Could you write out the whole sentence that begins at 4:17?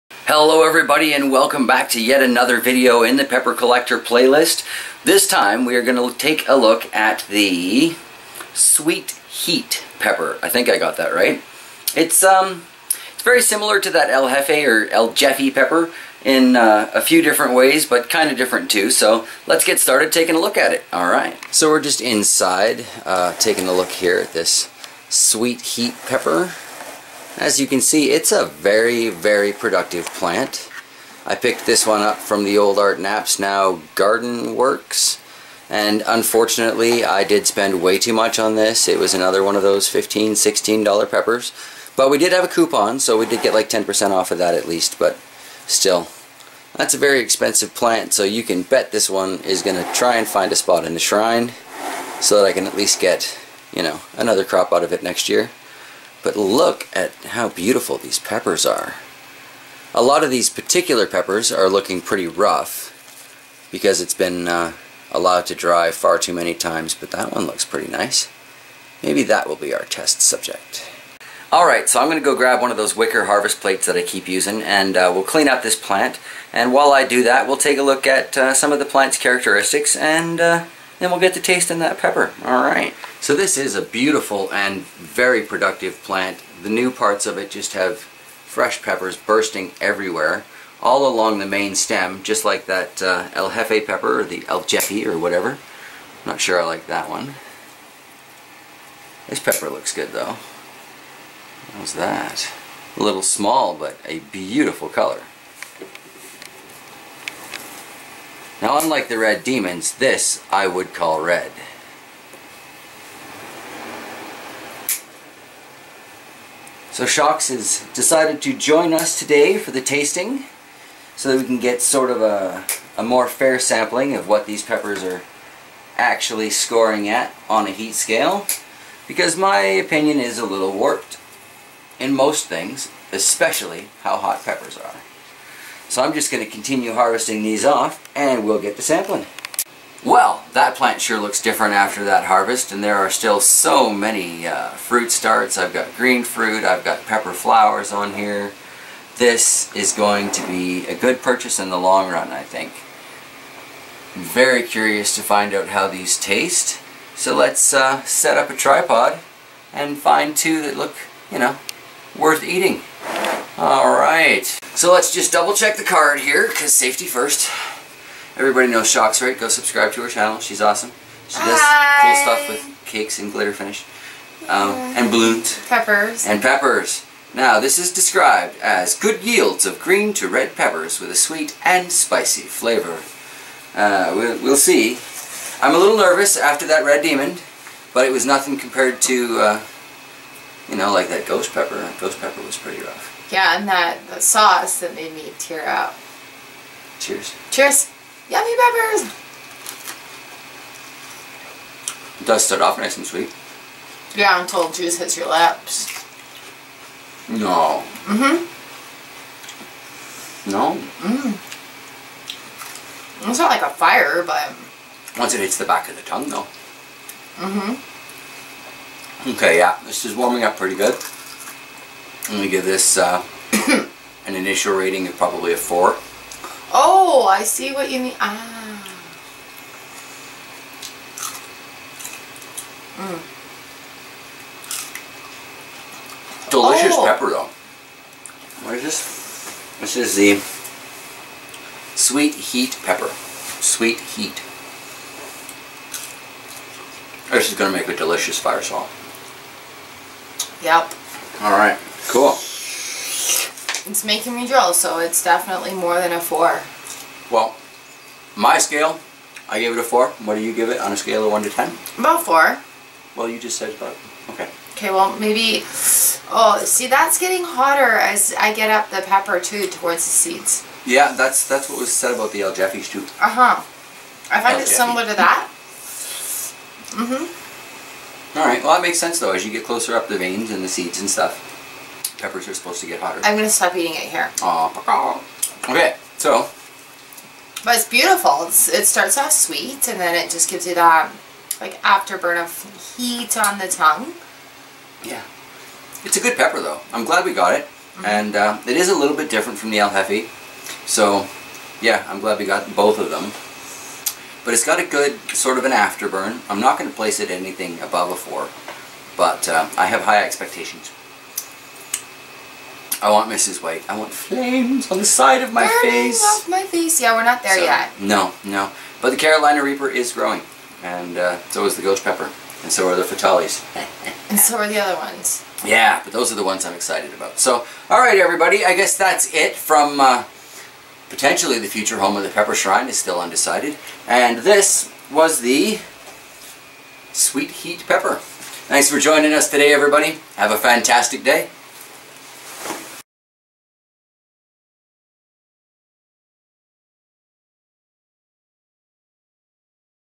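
Well, my scale, I gave it a four.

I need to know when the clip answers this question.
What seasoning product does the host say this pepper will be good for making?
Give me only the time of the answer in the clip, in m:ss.
4:08.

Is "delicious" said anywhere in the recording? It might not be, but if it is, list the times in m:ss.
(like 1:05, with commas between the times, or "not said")
3:56, 4:07.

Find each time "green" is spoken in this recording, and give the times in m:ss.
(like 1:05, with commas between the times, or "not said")
2:25, 2:59.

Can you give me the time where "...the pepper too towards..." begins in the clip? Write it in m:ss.
4:28.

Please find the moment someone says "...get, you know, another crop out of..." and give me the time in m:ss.
0:52.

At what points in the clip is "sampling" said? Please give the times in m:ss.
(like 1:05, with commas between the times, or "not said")
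2:03, 2:18.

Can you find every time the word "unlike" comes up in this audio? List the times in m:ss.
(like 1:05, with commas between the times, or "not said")
1:48.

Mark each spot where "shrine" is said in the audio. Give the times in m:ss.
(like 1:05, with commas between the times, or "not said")
0:50, 5:32.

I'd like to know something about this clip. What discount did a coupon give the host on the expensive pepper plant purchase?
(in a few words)
10%.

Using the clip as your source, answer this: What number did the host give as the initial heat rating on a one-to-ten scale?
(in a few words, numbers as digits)
4.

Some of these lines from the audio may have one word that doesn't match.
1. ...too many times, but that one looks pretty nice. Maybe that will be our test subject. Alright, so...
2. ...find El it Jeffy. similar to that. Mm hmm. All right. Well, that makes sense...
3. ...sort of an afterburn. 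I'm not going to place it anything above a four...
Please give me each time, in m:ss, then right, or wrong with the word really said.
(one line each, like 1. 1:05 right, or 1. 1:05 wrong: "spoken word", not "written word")
1. 1:06 right
2. 4:34 right
3. 5:05 right.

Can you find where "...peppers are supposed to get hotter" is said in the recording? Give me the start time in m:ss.
4:42.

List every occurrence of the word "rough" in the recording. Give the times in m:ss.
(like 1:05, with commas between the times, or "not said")
1:02, 3:12.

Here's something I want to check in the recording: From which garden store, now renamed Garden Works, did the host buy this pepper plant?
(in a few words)
Art Knapp's.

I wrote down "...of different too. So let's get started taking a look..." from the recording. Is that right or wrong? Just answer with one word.
right.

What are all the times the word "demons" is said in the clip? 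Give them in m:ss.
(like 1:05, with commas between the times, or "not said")
1:49, 3:07.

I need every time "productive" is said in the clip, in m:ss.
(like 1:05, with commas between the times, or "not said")
0:29, 1:25.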